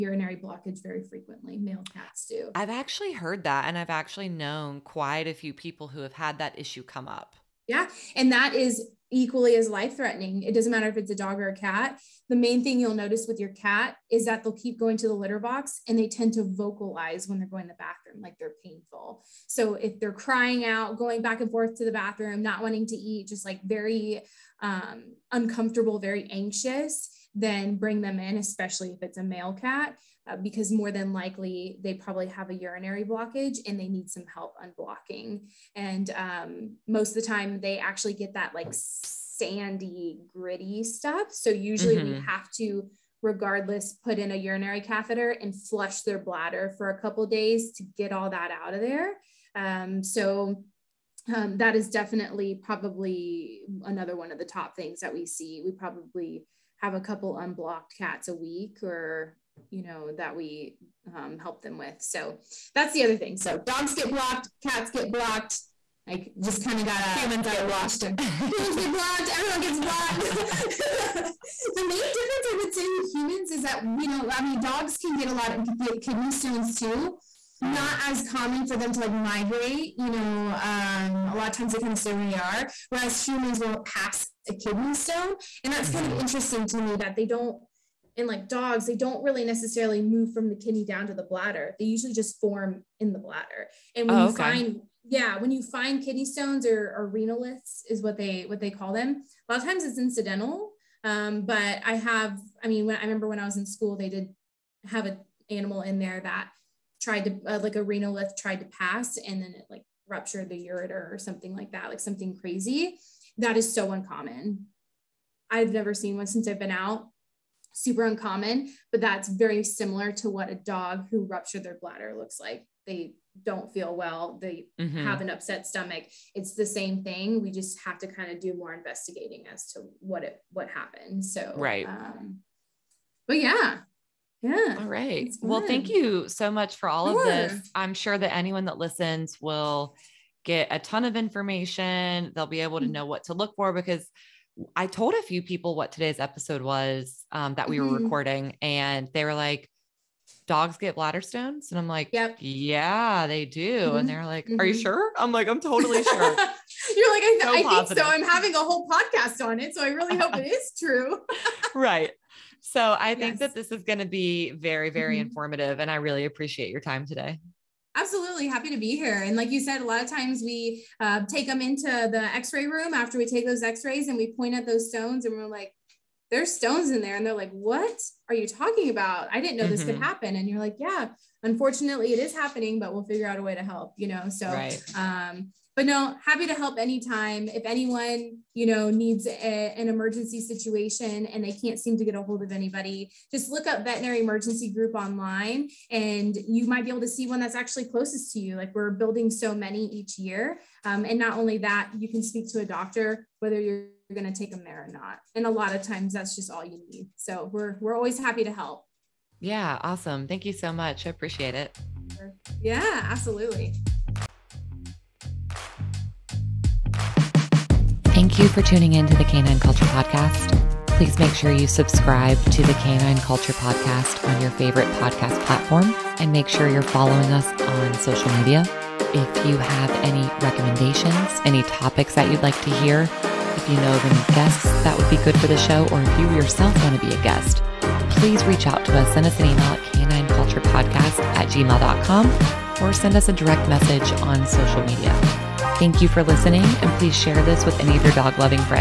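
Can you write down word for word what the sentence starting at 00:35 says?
And um, most of the time they actually get that like sandy, gritty stuff.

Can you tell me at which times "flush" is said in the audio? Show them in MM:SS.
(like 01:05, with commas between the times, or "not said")
00:45.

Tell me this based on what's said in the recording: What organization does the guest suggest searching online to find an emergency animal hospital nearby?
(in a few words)
Veterinary Emergency Group.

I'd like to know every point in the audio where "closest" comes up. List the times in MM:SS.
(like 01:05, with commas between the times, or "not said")
03:17.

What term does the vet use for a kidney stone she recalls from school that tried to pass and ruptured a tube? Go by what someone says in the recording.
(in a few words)
renalith.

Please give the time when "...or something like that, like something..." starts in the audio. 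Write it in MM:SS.
01:51.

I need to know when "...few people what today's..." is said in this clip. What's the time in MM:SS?
02:25.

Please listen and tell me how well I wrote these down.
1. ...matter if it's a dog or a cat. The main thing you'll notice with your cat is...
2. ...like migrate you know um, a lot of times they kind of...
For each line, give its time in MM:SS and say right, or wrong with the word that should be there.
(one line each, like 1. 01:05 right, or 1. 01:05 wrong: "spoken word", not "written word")
1. 00:10 right
2. 01:18 right.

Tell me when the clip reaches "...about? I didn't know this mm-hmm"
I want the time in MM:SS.
02:58.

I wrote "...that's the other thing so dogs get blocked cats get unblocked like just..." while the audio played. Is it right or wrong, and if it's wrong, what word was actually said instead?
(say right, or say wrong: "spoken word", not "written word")
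wrong: "blocked", not "unblocked".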